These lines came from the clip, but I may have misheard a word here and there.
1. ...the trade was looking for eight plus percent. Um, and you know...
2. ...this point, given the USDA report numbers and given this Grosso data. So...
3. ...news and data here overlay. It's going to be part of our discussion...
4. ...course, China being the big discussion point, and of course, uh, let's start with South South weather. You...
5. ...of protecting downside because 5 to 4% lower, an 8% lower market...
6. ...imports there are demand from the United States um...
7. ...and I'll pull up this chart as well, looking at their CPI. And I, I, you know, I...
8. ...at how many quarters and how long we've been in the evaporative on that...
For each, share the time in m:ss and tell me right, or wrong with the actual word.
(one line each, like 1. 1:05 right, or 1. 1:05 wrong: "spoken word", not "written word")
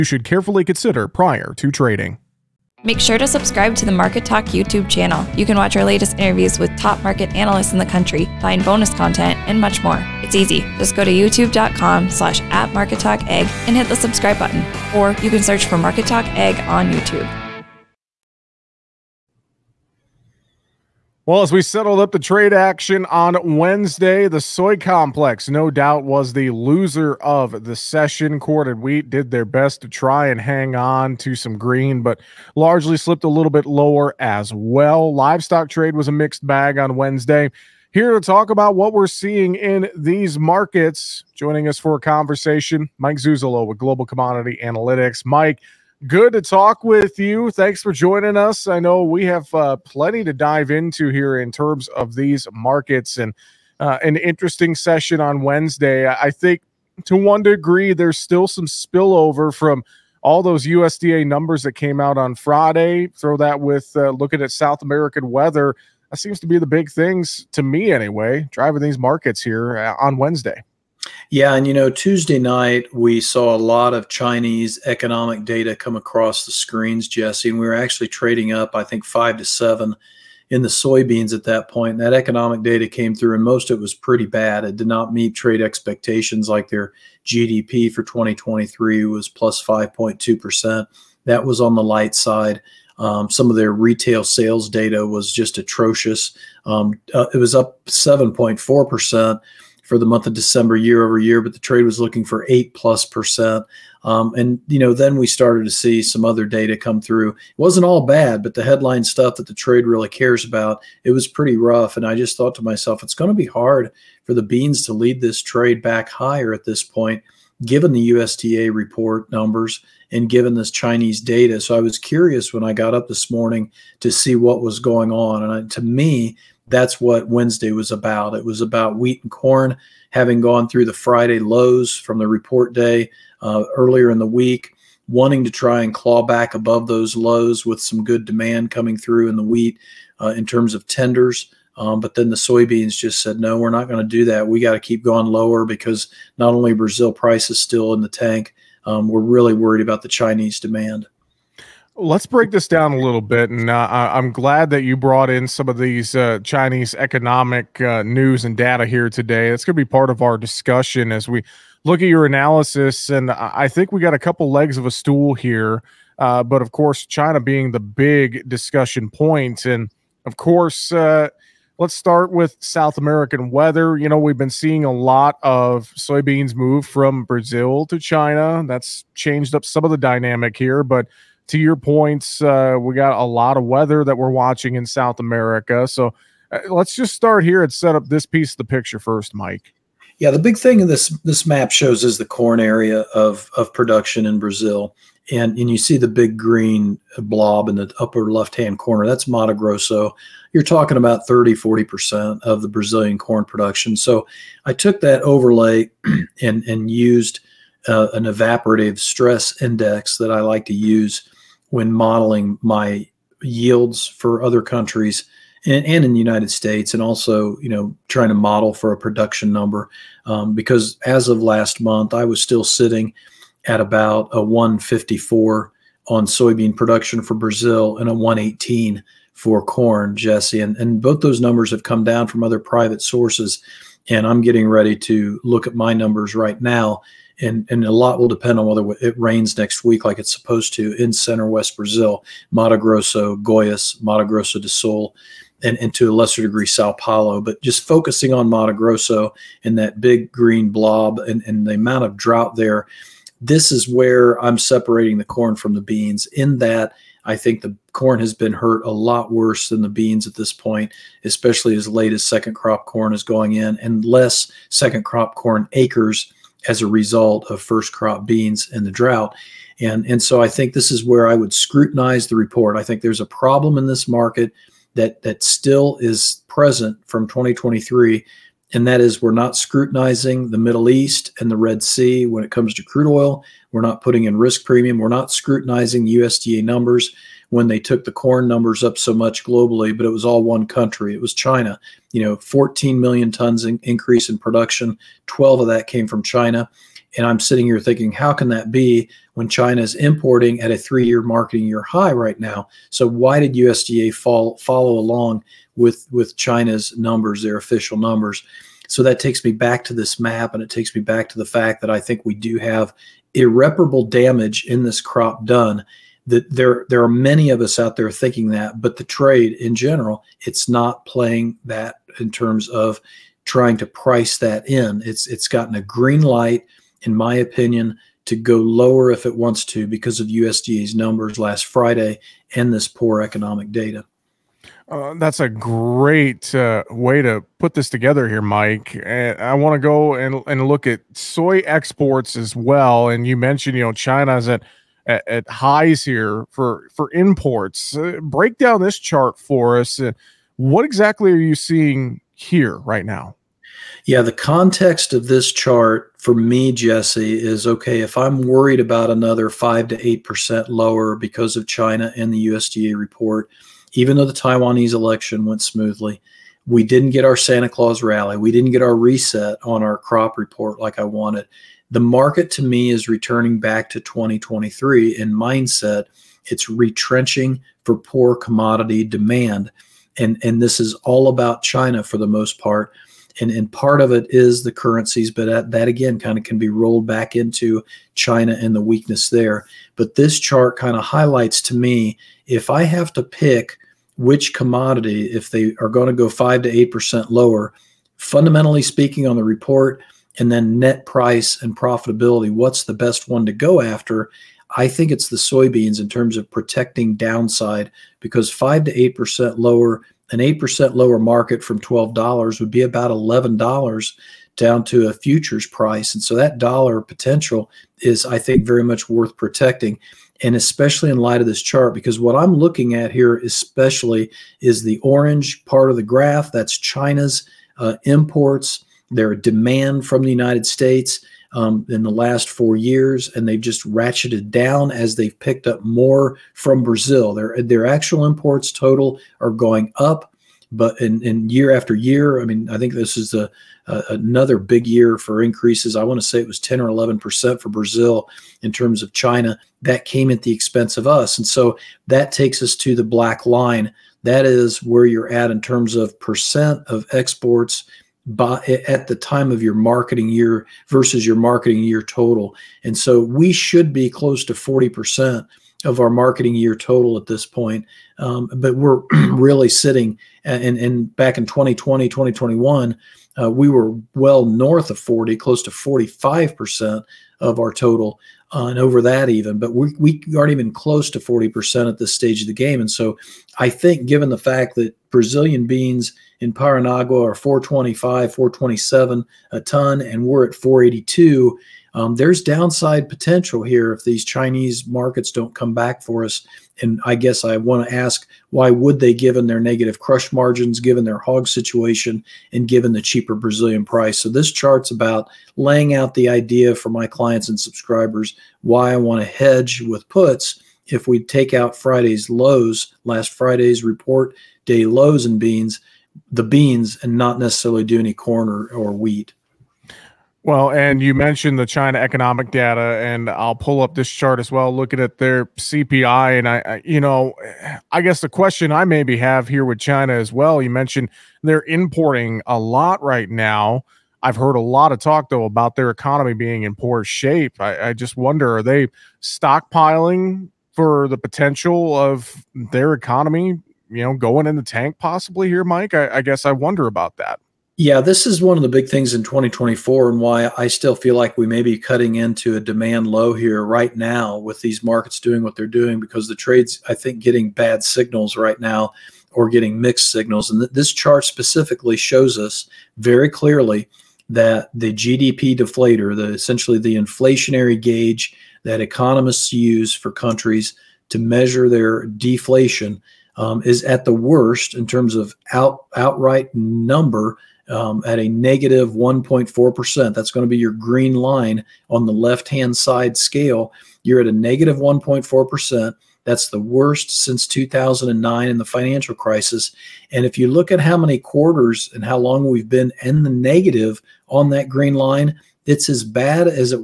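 1. 1:41 right
2. 1:56 wrong: "Chinese", not "Grosso"
3. 2:38 wrong: "today", not "overlay"
4. 2:46 wrong: "American", not "South"
5. 6:46 wrong: "8", not "4"
6. 7:08 right
7. 8:42 right
8. 9:50 wrong: "negative", not "evaporative".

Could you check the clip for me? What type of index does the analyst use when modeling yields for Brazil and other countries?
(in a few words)
evaporative stress index.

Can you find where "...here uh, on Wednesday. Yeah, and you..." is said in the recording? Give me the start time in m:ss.
1:09.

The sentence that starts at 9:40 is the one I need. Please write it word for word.
That's going to be your green line on the left hand side scale.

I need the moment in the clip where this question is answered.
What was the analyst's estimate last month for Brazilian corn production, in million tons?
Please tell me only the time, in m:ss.
3:48.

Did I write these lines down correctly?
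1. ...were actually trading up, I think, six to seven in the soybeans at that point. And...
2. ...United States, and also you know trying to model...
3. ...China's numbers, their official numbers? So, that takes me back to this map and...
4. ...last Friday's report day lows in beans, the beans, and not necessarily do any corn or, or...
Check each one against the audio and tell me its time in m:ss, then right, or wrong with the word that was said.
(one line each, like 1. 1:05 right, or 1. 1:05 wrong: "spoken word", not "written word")
1. 1:17 wrong: "five", not "six"
2. 3:36 right
3. 5:06 right
4. 8:33 right.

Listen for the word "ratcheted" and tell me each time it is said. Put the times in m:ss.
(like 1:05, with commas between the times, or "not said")
7:13.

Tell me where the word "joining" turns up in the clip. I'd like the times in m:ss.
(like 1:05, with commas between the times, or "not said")
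0:41, 0:47.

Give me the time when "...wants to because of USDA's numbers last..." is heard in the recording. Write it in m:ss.
5:29.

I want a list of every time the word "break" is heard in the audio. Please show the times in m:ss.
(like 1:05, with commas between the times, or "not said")
2:32, 5:48.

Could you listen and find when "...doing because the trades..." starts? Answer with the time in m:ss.
9:15.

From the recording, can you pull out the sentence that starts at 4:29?
And, and so I think this is where I would scrutinize the report.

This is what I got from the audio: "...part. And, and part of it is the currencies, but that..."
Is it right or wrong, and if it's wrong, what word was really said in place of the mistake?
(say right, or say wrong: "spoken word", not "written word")
right.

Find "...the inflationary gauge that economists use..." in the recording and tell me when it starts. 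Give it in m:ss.
9:26.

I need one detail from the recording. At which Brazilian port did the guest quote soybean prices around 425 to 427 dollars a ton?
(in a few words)
Paranagua.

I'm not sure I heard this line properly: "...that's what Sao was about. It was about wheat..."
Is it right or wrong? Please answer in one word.
wrong.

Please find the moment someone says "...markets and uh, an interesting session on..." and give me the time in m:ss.
0:52.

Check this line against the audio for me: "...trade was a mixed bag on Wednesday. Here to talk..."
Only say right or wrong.
right.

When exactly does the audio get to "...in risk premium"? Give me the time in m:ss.
4:44.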